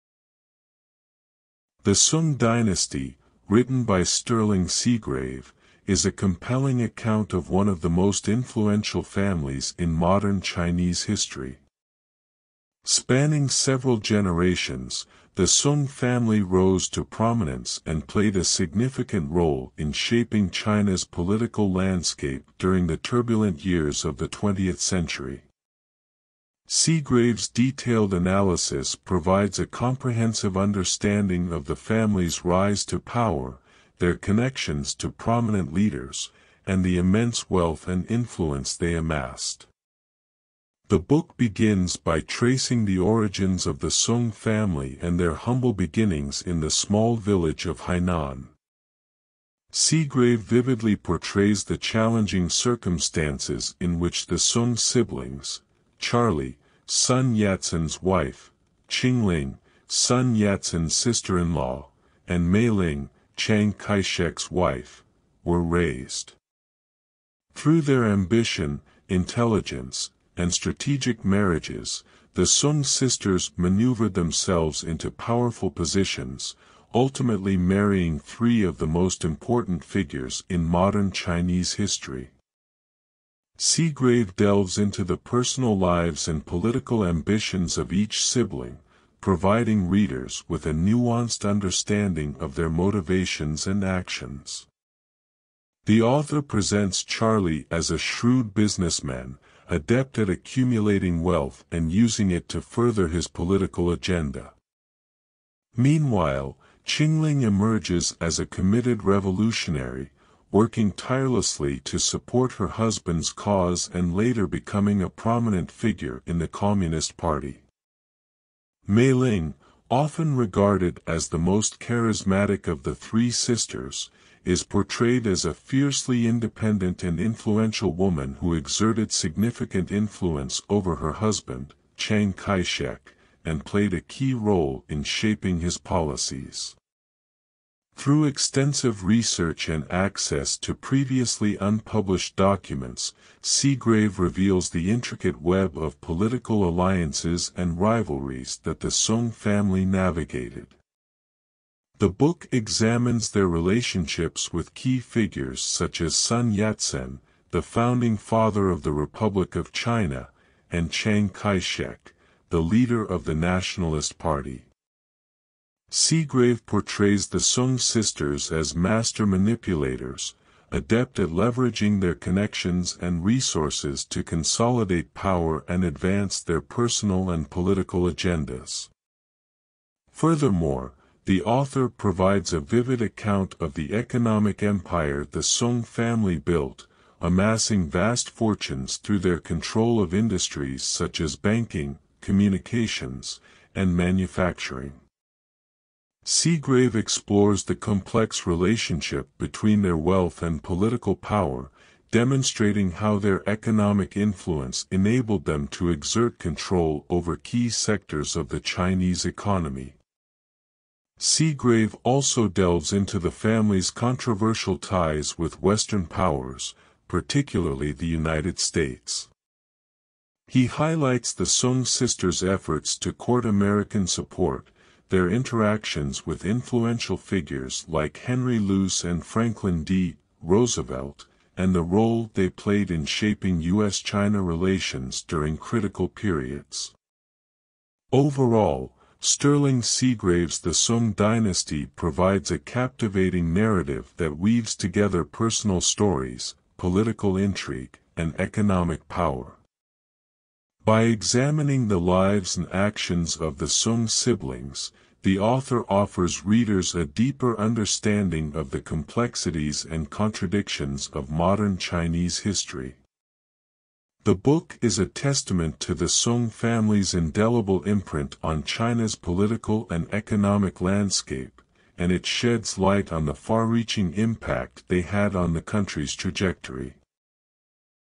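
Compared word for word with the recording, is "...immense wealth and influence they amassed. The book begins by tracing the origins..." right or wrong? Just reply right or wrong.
right.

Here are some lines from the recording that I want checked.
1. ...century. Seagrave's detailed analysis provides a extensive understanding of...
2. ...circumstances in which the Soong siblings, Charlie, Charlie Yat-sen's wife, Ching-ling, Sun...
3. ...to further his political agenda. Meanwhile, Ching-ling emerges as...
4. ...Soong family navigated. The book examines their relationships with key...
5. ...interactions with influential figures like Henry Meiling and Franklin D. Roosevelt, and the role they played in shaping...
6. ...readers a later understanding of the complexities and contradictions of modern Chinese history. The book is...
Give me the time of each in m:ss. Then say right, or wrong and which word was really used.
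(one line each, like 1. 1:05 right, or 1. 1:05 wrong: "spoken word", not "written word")
1. 0:24 wrong: "comprehensive", not "extensive"
2. 0:52 wrong: "Sun", not "Charlie"
3. 1:42 right
4. 2:28 right
5. 3:45 wrong: "Luce", not "Meiling"
6. 4:16 wrong: "deeper", not "later".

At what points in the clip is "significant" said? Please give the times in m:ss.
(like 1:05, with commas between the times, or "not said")
0:18, 2:09.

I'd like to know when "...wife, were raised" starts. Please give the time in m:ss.
1:04.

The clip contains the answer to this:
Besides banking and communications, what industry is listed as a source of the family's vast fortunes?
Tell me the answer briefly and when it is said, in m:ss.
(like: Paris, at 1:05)
manufacturing, at 3:13.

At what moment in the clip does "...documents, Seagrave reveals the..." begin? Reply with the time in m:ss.
2:22.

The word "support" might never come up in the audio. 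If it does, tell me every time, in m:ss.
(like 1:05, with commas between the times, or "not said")
1:51, 3:44.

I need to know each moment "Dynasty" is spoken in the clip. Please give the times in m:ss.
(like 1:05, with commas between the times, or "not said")
0:02, 4:01.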